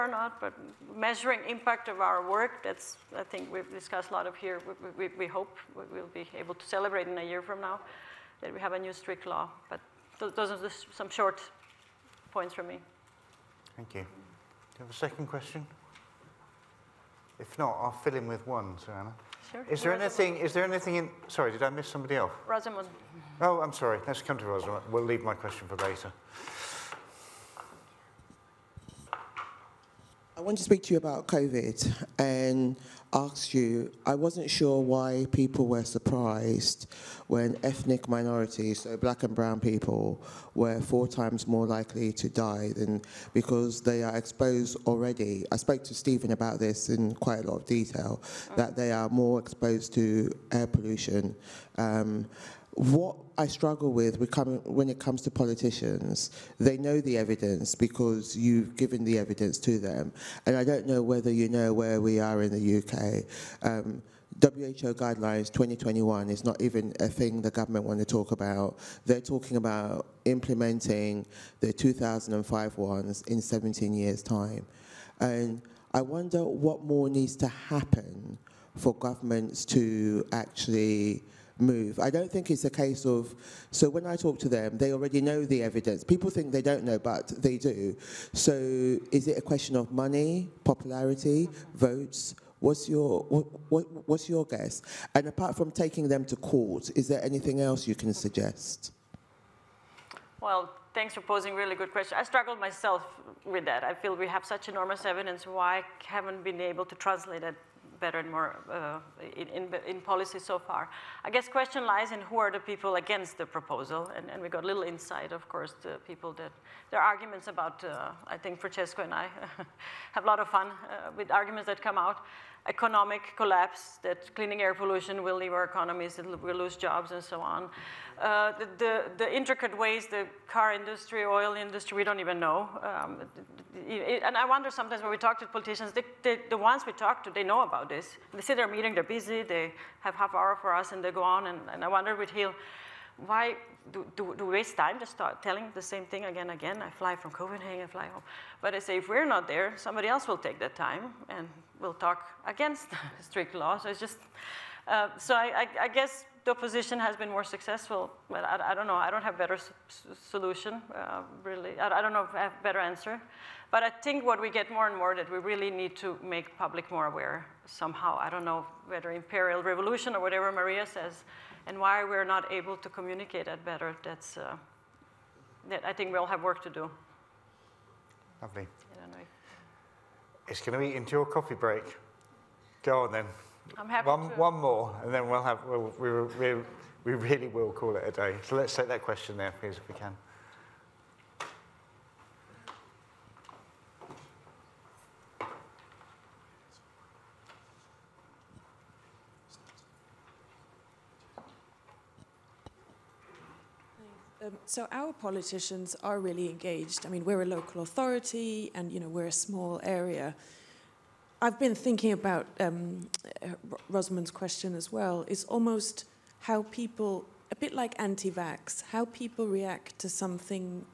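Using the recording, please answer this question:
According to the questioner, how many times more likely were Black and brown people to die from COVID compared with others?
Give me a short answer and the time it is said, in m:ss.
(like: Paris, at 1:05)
4 times, at 0:40.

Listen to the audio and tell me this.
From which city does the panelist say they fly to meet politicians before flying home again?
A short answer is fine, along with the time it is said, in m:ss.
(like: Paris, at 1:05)
Copenhagen, at 2:27.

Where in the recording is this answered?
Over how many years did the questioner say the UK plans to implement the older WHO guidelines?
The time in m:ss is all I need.
1:13.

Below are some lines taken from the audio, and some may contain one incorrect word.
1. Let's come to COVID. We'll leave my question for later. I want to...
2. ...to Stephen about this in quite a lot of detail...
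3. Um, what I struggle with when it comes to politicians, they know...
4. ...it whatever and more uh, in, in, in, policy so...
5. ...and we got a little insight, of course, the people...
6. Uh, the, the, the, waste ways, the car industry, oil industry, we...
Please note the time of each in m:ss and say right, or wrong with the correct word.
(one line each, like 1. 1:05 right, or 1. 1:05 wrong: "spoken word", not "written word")
1. 0:24 wrong: "Rosamund", not "COVID"
2. 0:45 right
3. 0:51 right
4. 1:47 wrong: "better", not "whatever"
5. 1:54 right
6. 2:08 wrong: "intricate", not "waste".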